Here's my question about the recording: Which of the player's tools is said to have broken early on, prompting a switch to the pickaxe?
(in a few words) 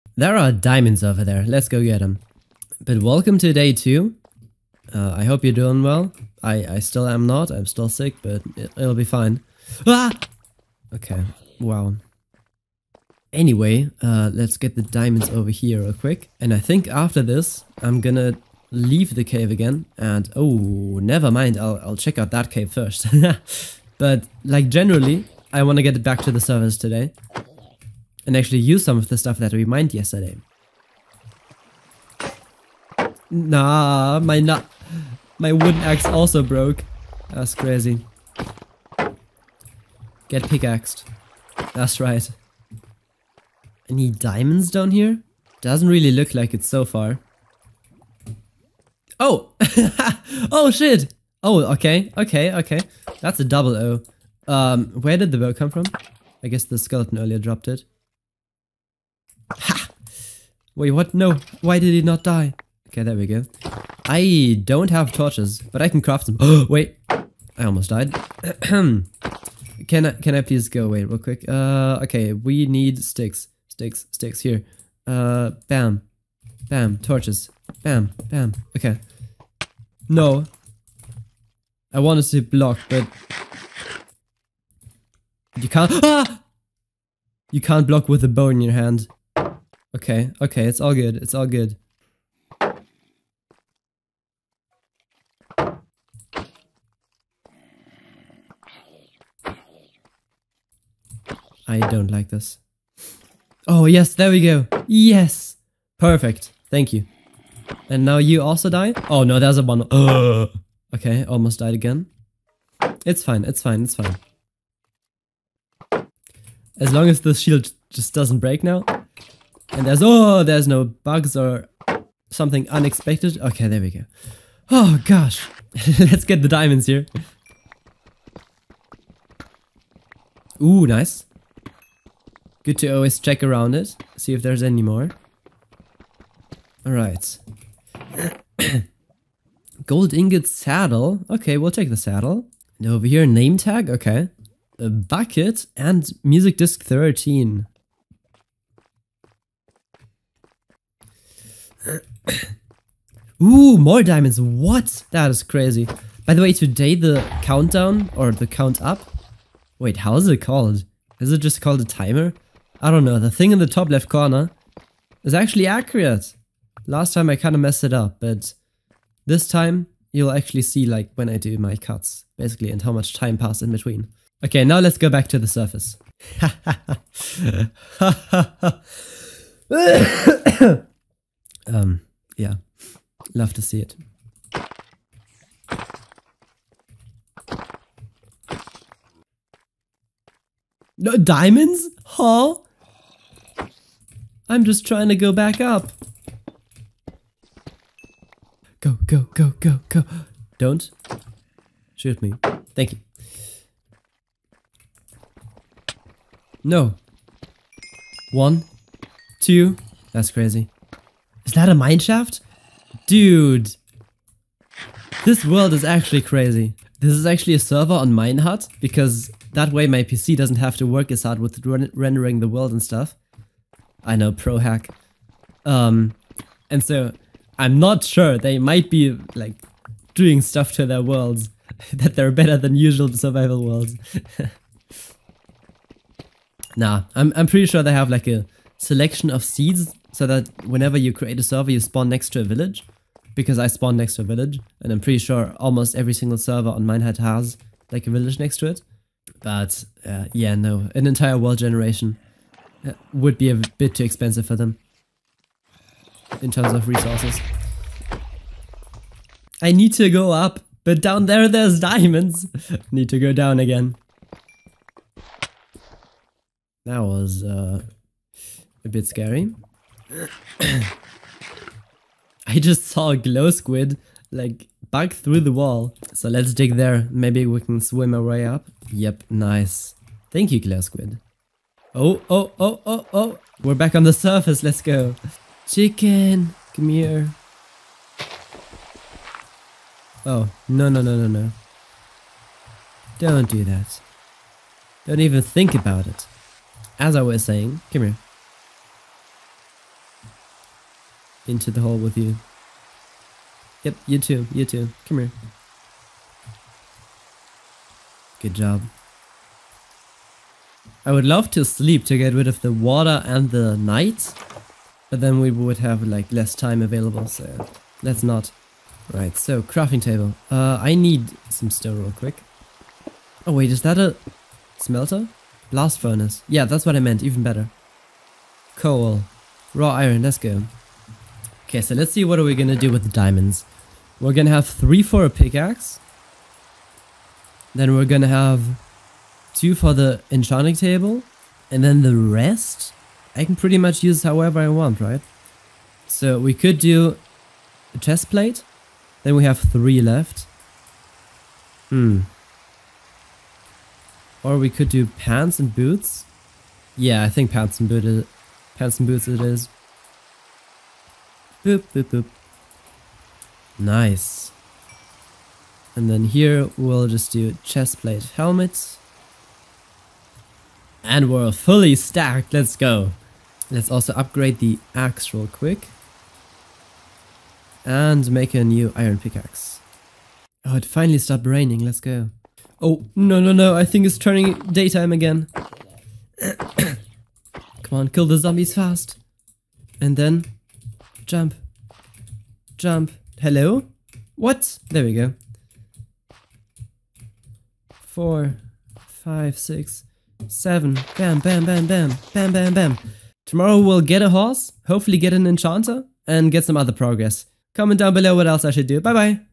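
wooden axe.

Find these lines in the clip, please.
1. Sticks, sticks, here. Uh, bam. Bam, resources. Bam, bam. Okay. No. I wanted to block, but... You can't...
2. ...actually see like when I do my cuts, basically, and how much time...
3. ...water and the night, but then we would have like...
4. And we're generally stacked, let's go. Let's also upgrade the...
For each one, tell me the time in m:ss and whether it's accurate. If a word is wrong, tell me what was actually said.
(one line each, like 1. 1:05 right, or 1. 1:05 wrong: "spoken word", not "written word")
1. 1:13 wrong: "torches", not "resources"
2. 2:50 right
3. 5:12 right
4. 6:11 wrong: "fully", not "generally".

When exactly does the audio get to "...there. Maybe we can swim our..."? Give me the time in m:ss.
4:36.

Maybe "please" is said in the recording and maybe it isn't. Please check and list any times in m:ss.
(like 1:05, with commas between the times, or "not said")
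1:10.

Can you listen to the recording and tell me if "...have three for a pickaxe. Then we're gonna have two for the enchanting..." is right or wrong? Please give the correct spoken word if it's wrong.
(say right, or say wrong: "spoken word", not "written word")
right.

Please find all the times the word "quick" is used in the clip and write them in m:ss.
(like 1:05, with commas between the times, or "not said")
0:15, 1:11, 5:22, 6:15.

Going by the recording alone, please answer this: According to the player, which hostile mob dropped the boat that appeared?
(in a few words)
skeleton.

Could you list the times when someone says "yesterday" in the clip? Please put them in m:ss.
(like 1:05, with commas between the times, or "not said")
0:29.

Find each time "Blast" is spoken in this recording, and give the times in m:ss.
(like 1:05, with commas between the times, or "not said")
5:25.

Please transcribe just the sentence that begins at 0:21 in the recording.
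I'll, I'll check out that cave first.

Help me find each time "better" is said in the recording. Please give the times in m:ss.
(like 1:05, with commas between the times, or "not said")
3:52, 5:27.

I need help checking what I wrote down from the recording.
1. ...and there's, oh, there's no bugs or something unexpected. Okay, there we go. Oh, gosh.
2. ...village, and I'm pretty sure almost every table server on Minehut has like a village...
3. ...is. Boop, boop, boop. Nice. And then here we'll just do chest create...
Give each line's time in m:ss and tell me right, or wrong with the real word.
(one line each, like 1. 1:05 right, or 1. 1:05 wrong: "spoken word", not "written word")
1. 1:59 right
2. 4:04 wrong: "single", not "table"
3. 5:59 wrong: "plate", not "create".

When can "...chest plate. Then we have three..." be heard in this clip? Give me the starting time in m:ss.
5:47.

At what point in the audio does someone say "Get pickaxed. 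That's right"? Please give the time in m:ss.
0:40.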